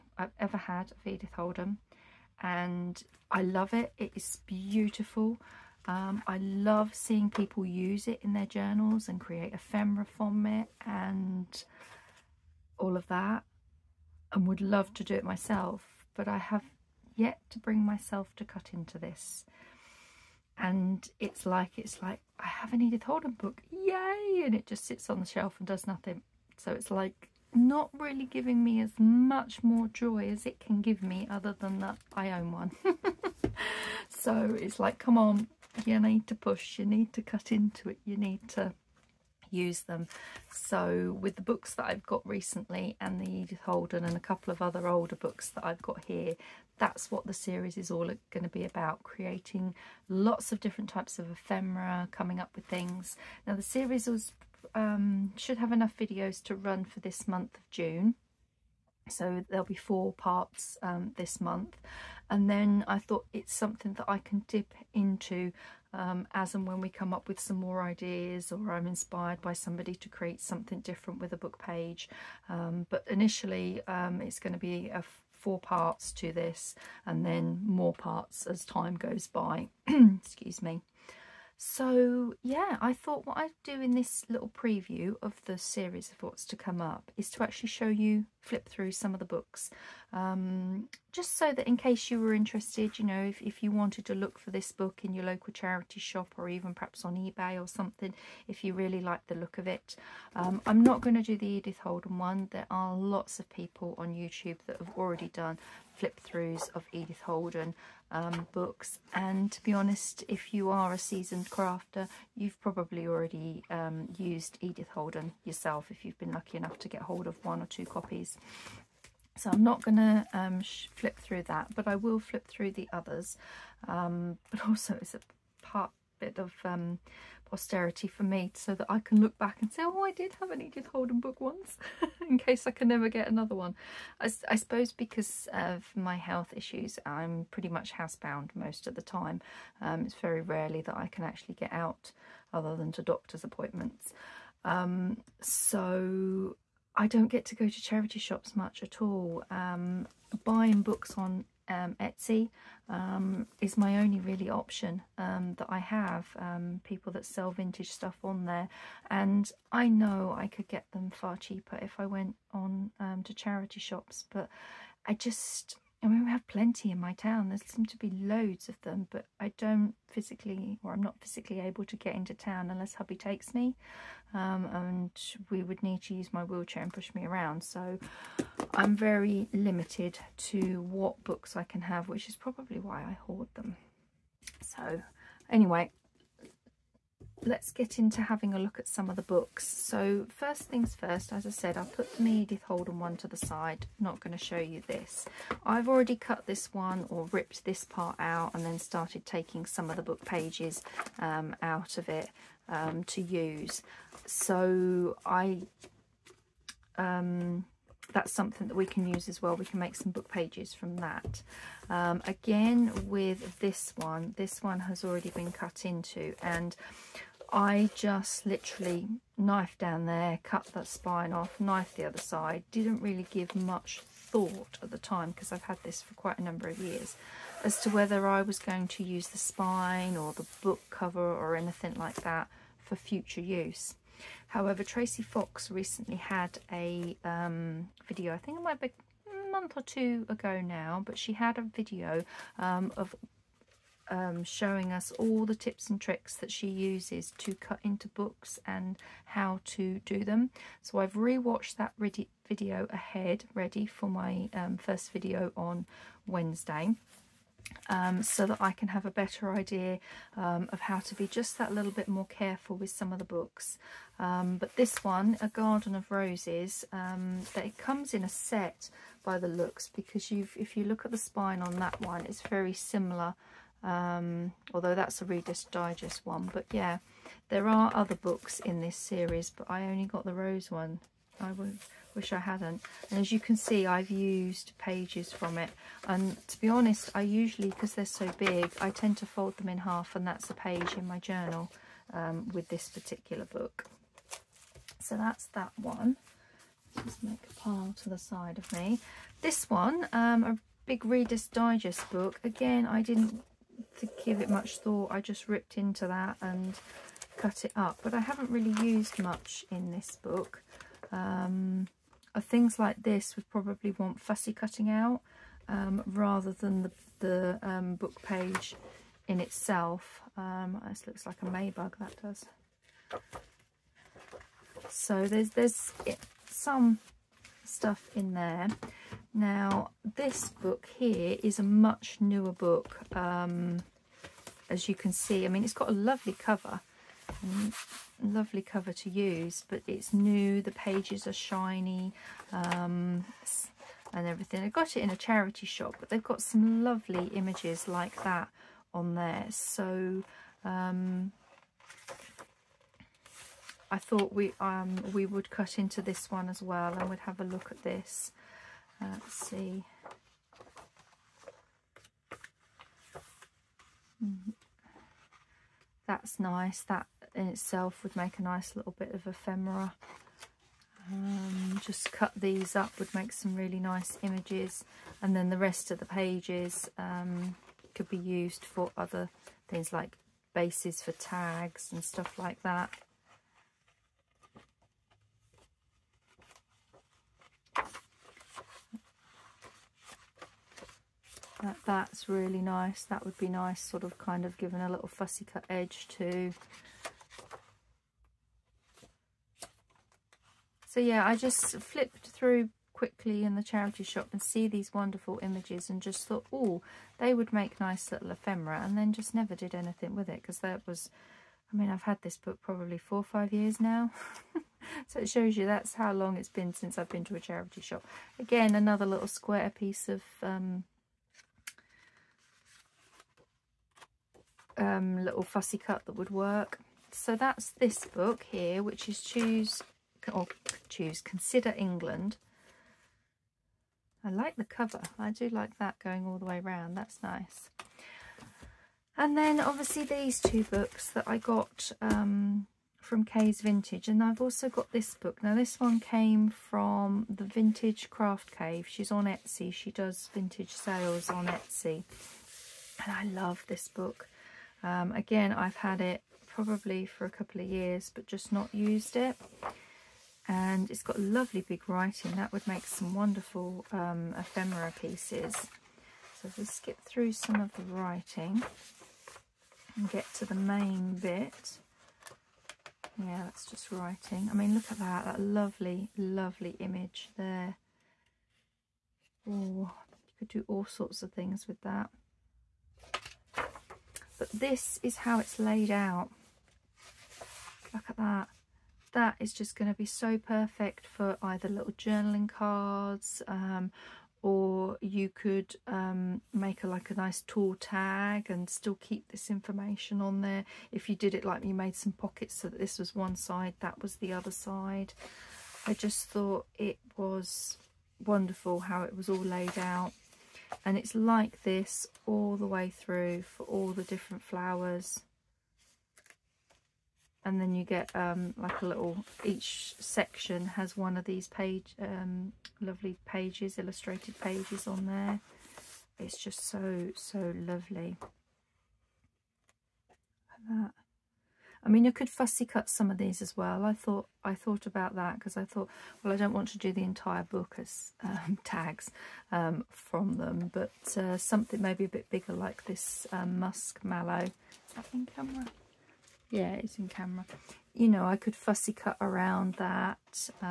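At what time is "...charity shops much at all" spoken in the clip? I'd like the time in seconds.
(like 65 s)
147 s.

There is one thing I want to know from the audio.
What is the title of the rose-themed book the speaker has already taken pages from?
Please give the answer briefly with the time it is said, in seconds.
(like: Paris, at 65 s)
A Garden of Roses, at 265 s.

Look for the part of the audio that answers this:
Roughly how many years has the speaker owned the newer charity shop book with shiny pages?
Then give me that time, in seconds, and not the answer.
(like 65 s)
412 s.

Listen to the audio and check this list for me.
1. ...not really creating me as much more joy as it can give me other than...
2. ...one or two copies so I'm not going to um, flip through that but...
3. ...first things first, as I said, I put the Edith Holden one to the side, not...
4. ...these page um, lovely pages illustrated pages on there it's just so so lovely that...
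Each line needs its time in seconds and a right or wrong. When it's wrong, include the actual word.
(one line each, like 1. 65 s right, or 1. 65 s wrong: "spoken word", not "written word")
1. 27 s wrong: "giving", not "creating"
2. 117 s right
3. 190 s right
4. 521 s right.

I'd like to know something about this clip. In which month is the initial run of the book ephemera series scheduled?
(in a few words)
June.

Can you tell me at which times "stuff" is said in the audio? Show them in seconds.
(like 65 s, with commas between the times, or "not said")
157 s, 327 s, 382 s.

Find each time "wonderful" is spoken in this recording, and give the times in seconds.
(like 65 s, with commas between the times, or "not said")
404 s, 463 s, 508 s.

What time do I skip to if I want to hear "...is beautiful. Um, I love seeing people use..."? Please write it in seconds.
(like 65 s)
4 s.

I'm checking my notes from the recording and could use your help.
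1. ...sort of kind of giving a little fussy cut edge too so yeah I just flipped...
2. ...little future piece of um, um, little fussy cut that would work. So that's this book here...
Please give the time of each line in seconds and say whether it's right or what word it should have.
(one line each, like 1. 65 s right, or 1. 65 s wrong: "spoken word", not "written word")
1. 393 s right
2. 419 s wrong: "square", not "future".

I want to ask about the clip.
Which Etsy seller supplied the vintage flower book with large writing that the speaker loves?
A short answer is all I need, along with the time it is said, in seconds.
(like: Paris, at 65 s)
Vintage Craft Cave, at 447 s.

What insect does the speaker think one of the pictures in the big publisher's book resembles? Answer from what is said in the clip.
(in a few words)
A maybug.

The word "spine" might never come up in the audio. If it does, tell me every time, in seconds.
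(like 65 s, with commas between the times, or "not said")
220 s, 229 s, 271 s.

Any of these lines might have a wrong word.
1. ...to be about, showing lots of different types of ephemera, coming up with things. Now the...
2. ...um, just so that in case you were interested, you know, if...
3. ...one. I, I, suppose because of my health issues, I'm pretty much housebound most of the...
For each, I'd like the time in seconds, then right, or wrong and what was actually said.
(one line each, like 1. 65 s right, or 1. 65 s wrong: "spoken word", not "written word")
1. 48 s wrong: "creating", not "showing"
2. 90 s right
3. 133 s right.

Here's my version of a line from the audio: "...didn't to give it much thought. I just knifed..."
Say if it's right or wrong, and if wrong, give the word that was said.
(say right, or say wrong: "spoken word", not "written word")
wrong: "ripped", not "knifed".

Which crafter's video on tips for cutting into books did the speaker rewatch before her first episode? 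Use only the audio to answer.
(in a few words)
Tracy Fox.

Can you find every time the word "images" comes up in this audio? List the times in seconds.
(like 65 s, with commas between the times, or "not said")
347 s, 374 s, 405 s, 476 s.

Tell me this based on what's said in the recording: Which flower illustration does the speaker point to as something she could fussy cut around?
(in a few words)
Musk mallow.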